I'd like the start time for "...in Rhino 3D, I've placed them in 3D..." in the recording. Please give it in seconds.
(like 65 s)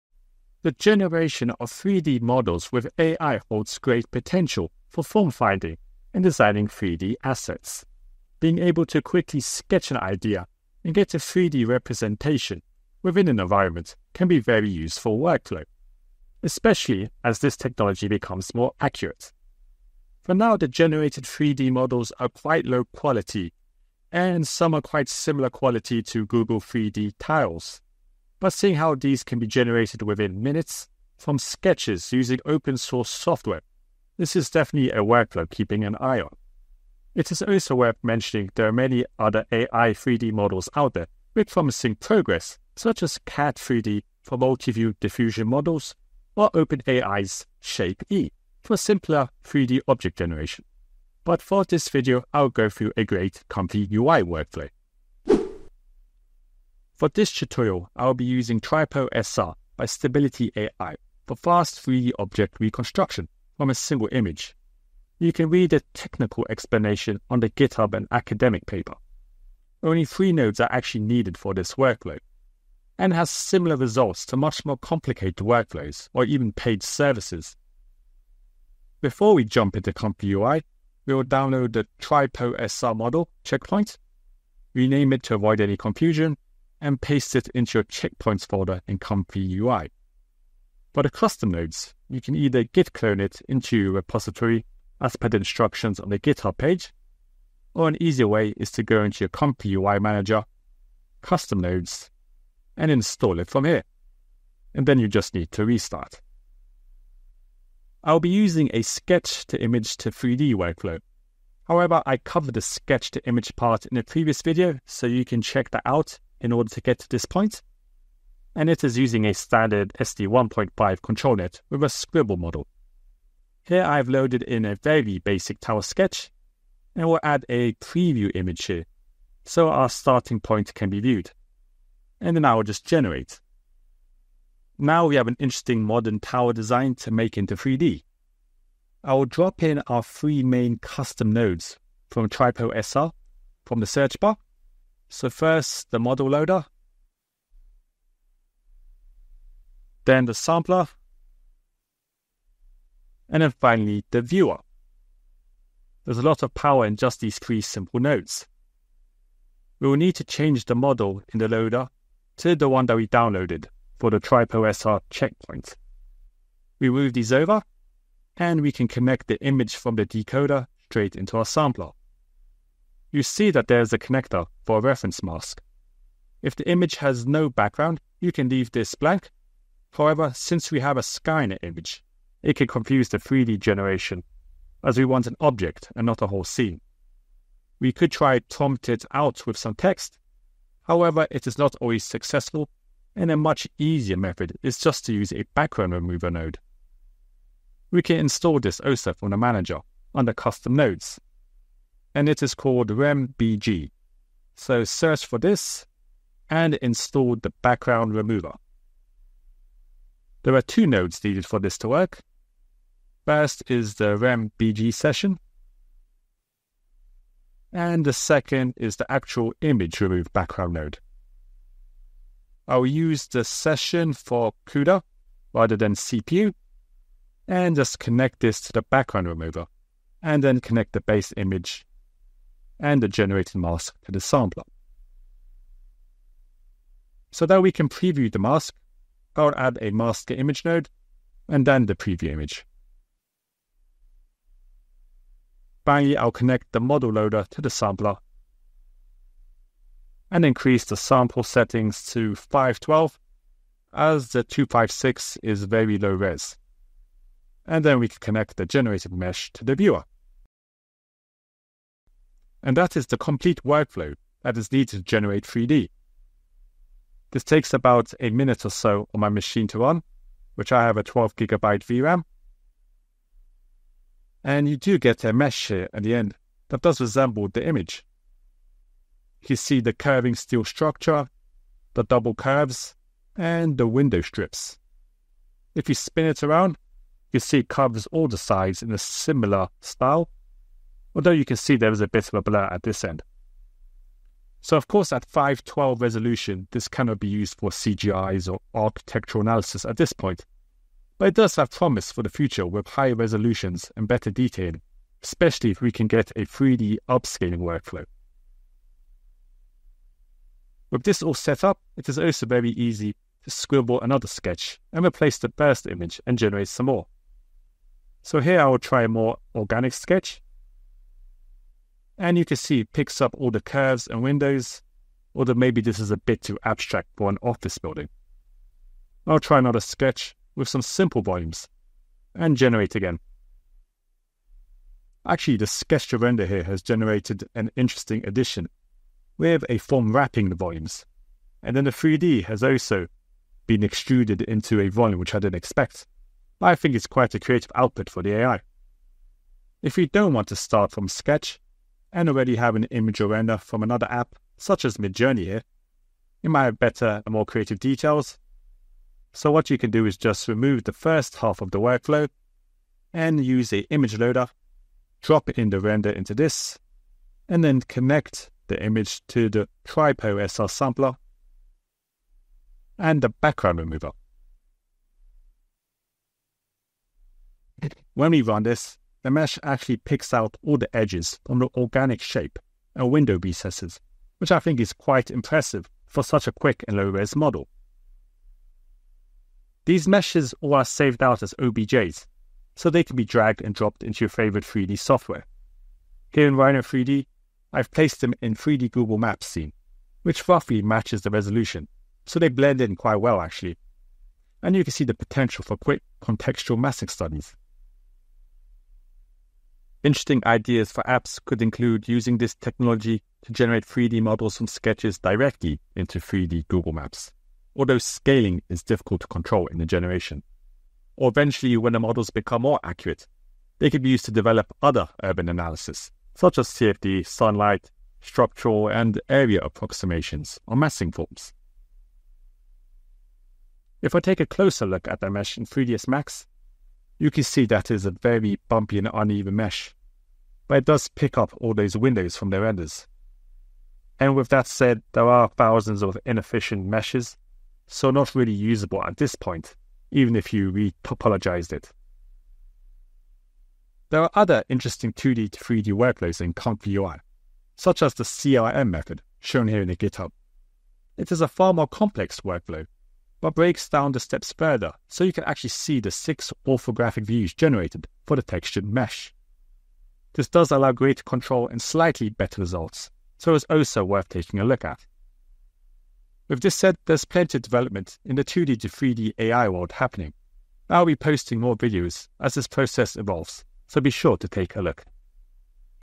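396 s.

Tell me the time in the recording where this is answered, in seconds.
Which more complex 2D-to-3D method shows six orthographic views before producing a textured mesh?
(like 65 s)
458 s.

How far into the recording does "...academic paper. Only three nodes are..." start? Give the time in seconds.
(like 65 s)
68 s.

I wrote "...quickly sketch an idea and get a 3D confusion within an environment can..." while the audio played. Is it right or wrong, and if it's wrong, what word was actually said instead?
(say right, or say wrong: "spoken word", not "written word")
wrong: "representation", not "confusion".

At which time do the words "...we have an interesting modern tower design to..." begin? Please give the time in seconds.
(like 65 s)
135 s.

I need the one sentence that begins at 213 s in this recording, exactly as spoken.
First is the RemBG session, and the second is the actual image remove background node.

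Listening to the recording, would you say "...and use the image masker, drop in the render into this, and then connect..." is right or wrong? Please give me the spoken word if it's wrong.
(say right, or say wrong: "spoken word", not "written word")
wrong: "loader", not "masker".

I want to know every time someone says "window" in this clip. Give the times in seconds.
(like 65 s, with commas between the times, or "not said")
283 s, 324 s, 383 s, 441 s.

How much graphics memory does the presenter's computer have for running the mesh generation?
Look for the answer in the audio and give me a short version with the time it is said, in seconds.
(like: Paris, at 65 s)
12 gigabytes, at 271 s.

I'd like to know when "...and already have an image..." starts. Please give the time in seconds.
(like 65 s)
352 s.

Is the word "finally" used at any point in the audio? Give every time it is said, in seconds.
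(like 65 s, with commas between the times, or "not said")
153 s, 245 s.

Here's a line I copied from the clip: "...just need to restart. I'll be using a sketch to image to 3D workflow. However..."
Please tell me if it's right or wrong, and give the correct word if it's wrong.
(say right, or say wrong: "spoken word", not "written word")
right.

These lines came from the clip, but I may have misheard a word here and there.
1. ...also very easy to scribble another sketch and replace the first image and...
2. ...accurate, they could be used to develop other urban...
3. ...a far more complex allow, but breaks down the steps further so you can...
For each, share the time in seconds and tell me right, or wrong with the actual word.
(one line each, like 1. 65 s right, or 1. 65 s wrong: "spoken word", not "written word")
1. 312 s right
2. 422 s right
3. 461 s wrong: "workflow", not "allow".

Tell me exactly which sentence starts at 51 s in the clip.
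But for this video, I'll go through a great comfy UI workflow.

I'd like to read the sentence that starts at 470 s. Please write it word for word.
This does allow greater control and slightly better results, so it's also worth taking a look at.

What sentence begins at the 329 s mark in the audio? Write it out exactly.
I'll try another sketch with some simple volumes and generate again.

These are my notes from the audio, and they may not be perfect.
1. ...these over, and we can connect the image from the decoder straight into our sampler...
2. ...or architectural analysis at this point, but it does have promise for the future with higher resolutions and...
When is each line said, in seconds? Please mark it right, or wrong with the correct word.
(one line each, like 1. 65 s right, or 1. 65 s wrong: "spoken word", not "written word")
1. 167 s right
2. 298 s right.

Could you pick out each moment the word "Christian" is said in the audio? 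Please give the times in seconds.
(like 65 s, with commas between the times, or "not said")
not said.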